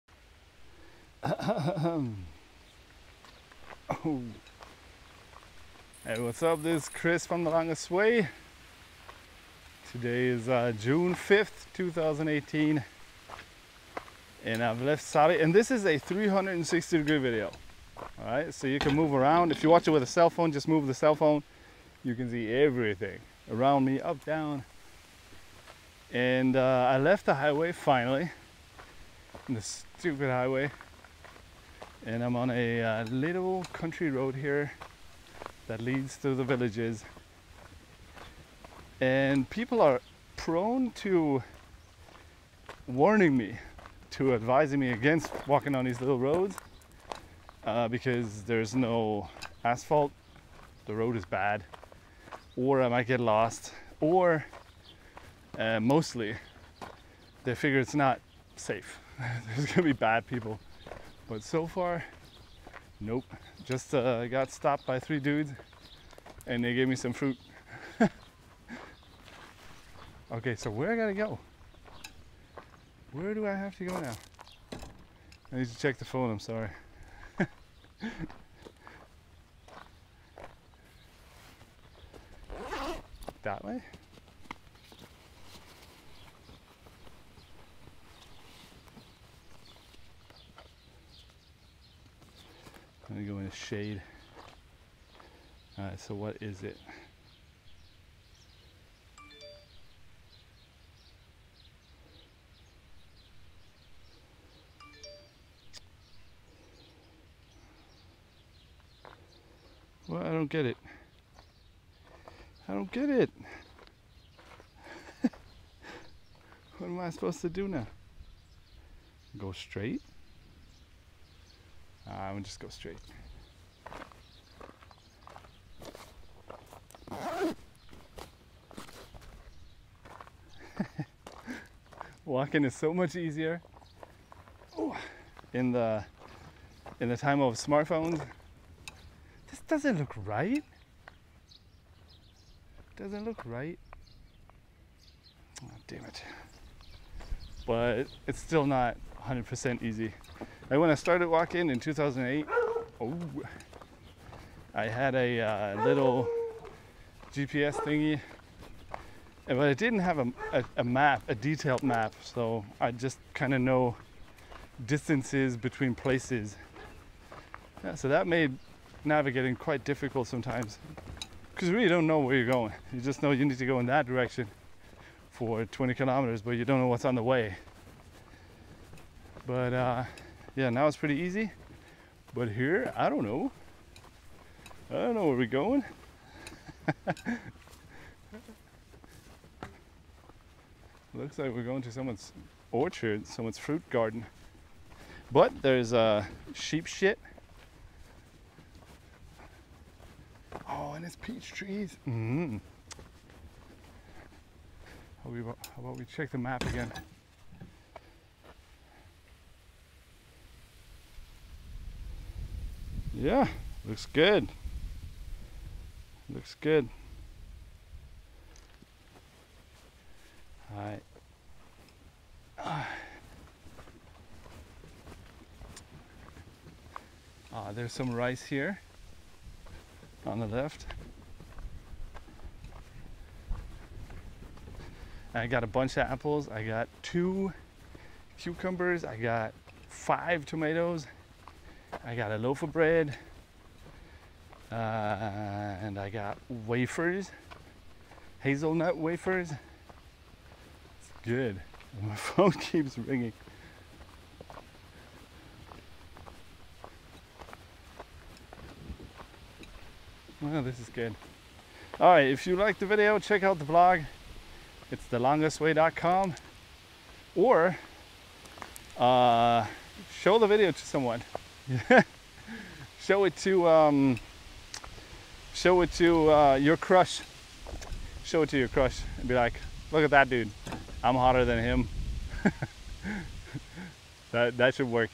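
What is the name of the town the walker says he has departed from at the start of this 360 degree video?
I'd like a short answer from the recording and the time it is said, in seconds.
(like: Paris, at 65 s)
Sari, at 15 s.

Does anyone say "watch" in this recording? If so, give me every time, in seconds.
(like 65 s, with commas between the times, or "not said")
19 s.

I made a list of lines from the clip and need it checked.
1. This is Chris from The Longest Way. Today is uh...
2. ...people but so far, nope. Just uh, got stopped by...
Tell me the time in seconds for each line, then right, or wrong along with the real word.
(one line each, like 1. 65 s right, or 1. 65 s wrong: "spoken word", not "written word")
1. 6 s right
2. 60 s right.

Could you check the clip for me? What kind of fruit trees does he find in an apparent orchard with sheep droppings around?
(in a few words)
Peach trees.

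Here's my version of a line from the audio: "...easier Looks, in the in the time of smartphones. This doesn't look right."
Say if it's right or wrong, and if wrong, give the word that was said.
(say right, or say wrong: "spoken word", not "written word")
wrong: "Ooh", not "Looks".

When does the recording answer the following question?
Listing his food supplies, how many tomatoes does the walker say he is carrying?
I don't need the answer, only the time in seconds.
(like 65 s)
239 s.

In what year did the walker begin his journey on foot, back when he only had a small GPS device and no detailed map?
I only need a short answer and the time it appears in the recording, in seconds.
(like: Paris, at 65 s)
2008, at 151 s.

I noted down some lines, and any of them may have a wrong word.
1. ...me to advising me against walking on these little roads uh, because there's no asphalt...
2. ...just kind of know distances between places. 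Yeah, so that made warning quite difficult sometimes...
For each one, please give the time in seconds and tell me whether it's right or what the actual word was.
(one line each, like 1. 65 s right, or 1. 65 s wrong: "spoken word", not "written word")
1. 43 s right
2. 162 s wrong: "navigating", not "warning".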